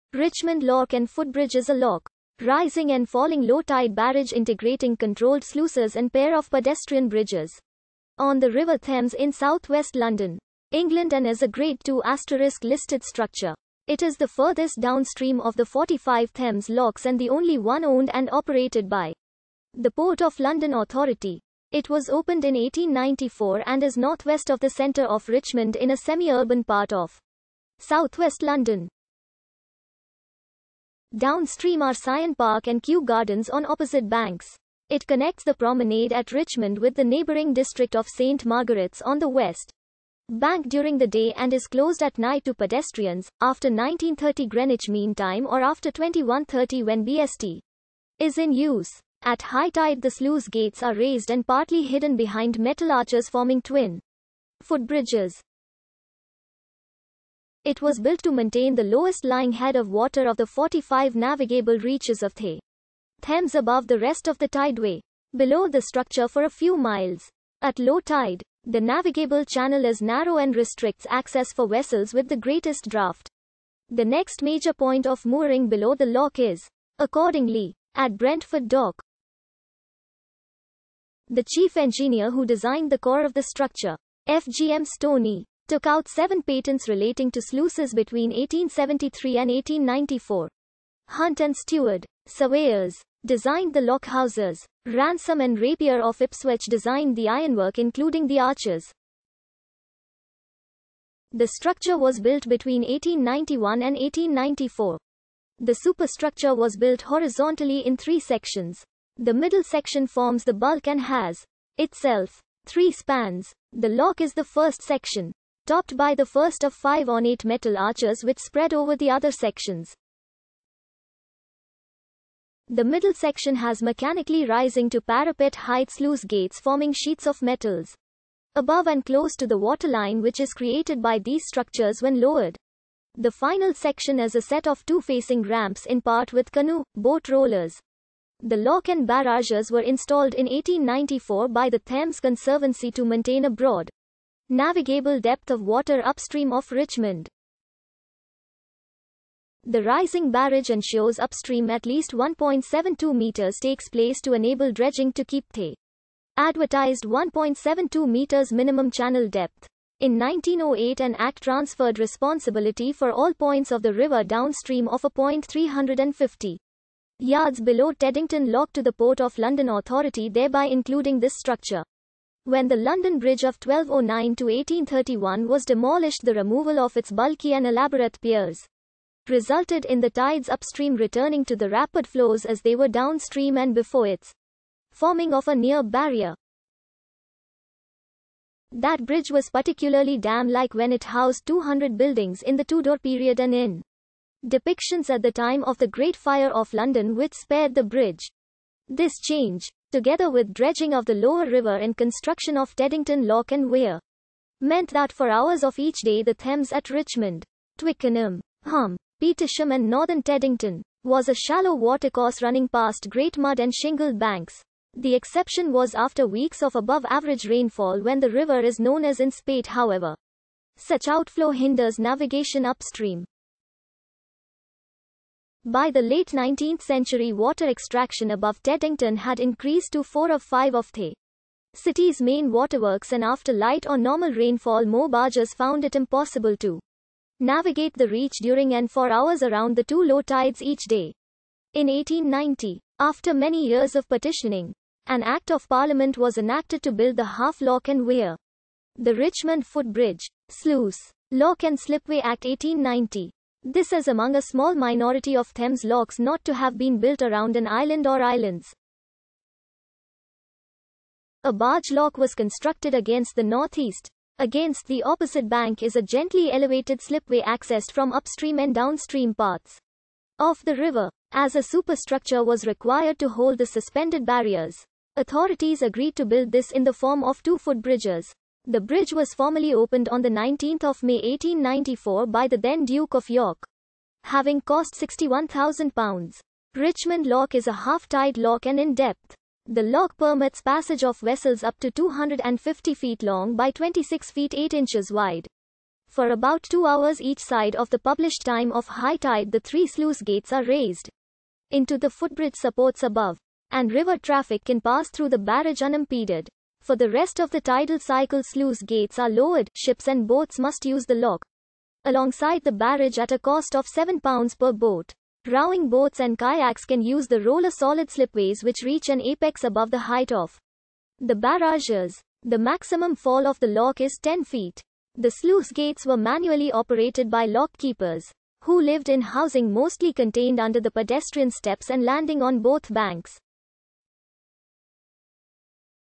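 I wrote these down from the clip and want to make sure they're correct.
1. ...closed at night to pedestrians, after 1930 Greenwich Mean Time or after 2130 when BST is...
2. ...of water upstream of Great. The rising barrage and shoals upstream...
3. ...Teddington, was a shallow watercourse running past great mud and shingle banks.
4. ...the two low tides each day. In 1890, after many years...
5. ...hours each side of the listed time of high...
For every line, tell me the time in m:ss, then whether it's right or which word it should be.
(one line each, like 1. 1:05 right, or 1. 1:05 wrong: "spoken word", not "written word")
1. 0:41 right
2. 2:25 wrong: "Richmond", not "Great"
3. 3:30 right
4. 3:59 right
5. 4:56 wrong: "published", not "listed".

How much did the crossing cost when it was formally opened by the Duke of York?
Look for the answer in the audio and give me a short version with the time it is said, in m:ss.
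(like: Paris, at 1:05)
£61,000, at 4:44.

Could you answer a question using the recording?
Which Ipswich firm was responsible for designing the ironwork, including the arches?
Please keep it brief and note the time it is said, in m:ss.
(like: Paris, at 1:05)
Ransom and Rapier, at 1:34.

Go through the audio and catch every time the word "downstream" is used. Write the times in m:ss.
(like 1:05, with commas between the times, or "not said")
0:14, 0:31, 2:44, 3:02, 4:28.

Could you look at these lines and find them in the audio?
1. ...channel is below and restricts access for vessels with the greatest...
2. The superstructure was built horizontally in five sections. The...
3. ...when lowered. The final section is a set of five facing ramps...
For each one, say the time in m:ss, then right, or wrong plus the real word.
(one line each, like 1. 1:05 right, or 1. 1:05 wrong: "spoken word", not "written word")
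1. 1:09 wrong: "narrow", not "below"
2. 1:45 wrong: "three", not "five"
3. 2:12 wrong: "two", not "five".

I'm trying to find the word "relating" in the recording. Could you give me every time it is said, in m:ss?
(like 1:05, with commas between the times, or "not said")
1:26.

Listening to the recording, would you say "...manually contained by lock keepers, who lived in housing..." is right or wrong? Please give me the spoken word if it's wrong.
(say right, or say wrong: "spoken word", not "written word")
wrong: "operated", not "contained".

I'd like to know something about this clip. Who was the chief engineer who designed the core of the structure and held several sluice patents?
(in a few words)
FGM Stoney.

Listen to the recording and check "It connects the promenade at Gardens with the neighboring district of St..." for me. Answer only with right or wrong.
wrong.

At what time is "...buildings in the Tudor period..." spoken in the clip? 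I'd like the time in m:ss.
3:11.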